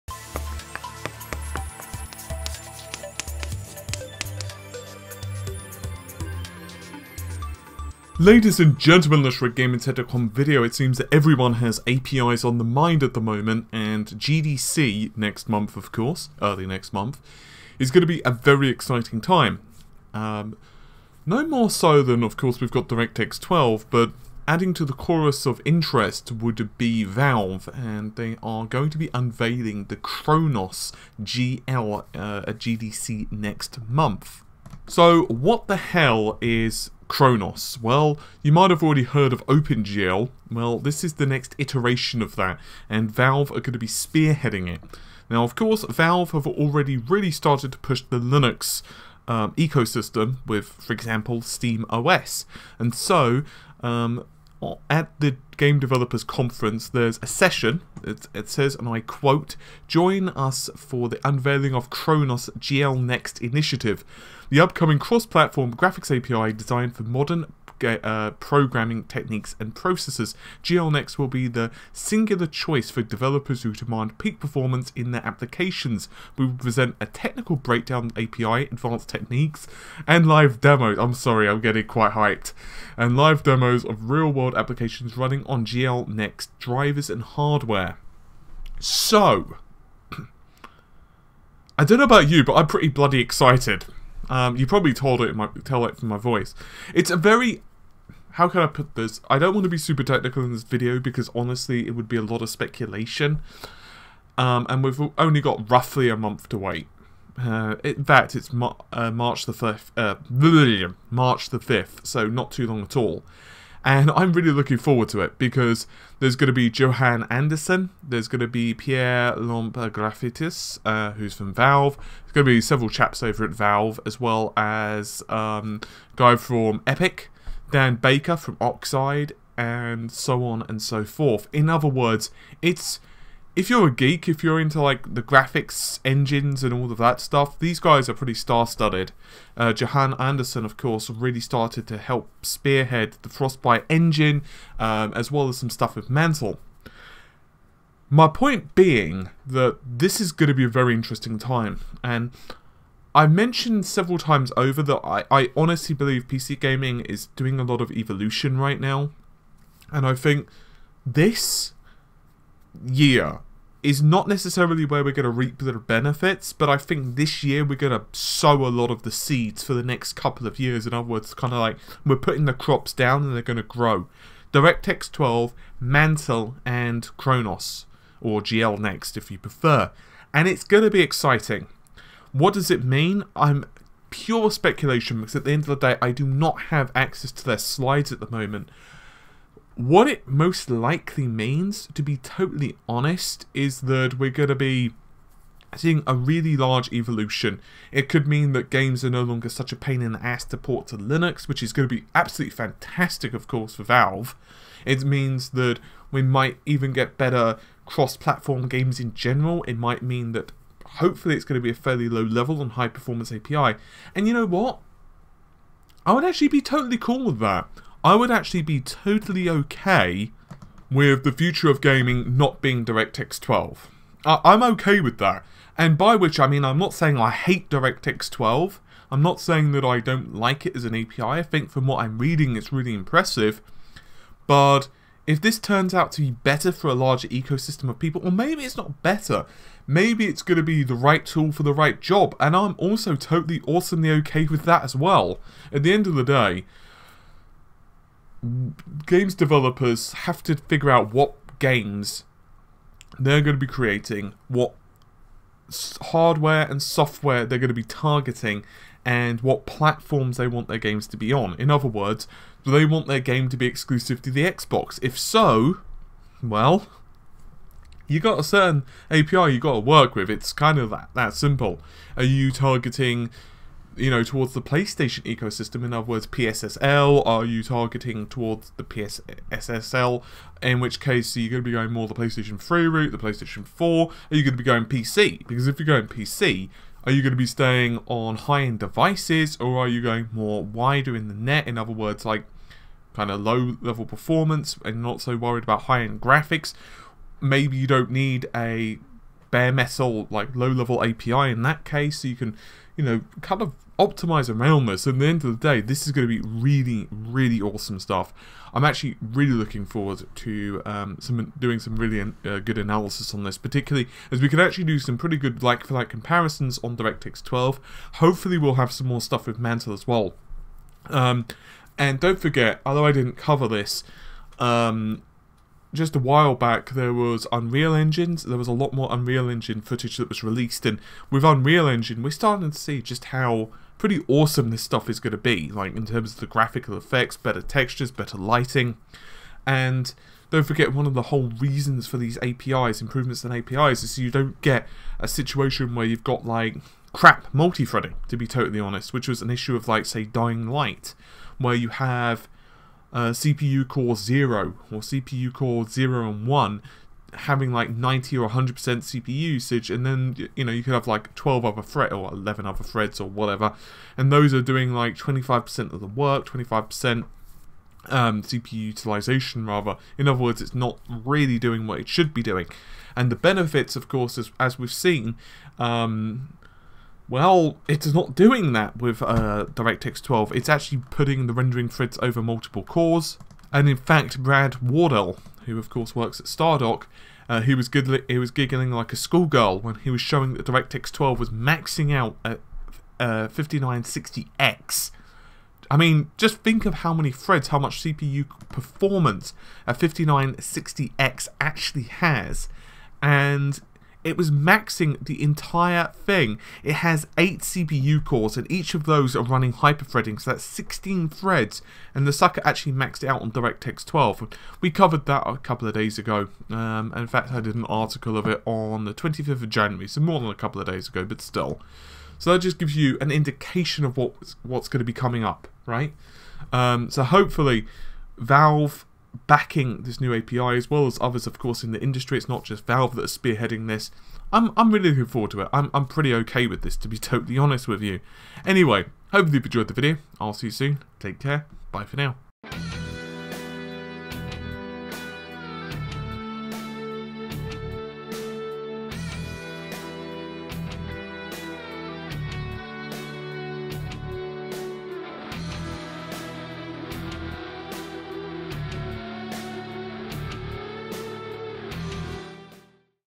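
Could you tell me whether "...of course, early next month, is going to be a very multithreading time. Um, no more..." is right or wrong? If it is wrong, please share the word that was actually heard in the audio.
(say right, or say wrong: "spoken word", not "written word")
wrong: "exciting", not "multithreading".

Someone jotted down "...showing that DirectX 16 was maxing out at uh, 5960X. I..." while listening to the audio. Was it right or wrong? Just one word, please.
wrong.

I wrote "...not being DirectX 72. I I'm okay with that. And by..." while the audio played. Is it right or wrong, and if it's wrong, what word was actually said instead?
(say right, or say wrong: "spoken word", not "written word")
wrong: "12", not "72".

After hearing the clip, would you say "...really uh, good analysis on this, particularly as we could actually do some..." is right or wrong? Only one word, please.
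right.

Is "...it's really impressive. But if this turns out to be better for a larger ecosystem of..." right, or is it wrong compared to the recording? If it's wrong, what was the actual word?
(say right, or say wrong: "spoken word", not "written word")
right.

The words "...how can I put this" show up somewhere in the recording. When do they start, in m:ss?
1:38.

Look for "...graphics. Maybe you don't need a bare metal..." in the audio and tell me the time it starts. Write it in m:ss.
4:56.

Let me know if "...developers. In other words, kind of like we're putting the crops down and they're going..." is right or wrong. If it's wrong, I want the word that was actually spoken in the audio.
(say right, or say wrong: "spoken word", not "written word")
wrong: "years", not "developers".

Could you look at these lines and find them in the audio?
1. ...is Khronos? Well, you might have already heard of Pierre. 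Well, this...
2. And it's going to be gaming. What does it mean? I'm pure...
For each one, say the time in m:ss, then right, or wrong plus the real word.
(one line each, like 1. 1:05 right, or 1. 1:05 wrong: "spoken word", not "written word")
1. 0:36 wrong: "OpenGL", not "Pierre"
2. 3:00 wrong: "exciting", not "gaming".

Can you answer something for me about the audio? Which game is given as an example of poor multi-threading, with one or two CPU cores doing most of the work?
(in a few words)
Dying Light.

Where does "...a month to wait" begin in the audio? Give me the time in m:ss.
1:46.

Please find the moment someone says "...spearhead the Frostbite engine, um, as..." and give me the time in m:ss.
2:22.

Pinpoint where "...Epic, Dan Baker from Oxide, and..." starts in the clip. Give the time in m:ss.
2:06.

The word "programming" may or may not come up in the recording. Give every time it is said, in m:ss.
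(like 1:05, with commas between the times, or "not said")
1:08.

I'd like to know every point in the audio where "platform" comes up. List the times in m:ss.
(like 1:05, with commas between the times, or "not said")
1:05, 3:27, 4:19.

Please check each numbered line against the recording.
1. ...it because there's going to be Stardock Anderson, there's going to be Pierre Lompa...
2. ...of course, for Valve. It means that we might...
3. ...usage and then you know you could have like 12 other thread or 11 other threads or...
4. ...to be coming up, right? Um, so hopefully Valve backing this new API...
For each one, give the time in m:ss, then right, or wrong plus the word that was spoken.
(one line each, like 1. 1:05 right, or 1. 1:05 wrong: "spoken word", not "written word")
1. 1:55 wrong: "Johan", not "Stardock"
2. 3:23 right
3. 5:59 right
4. 7:04 right.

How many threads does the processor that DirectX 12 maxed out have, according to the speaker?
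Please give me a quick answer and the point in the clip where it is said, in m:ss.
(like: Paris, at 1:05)
16, at 6:50.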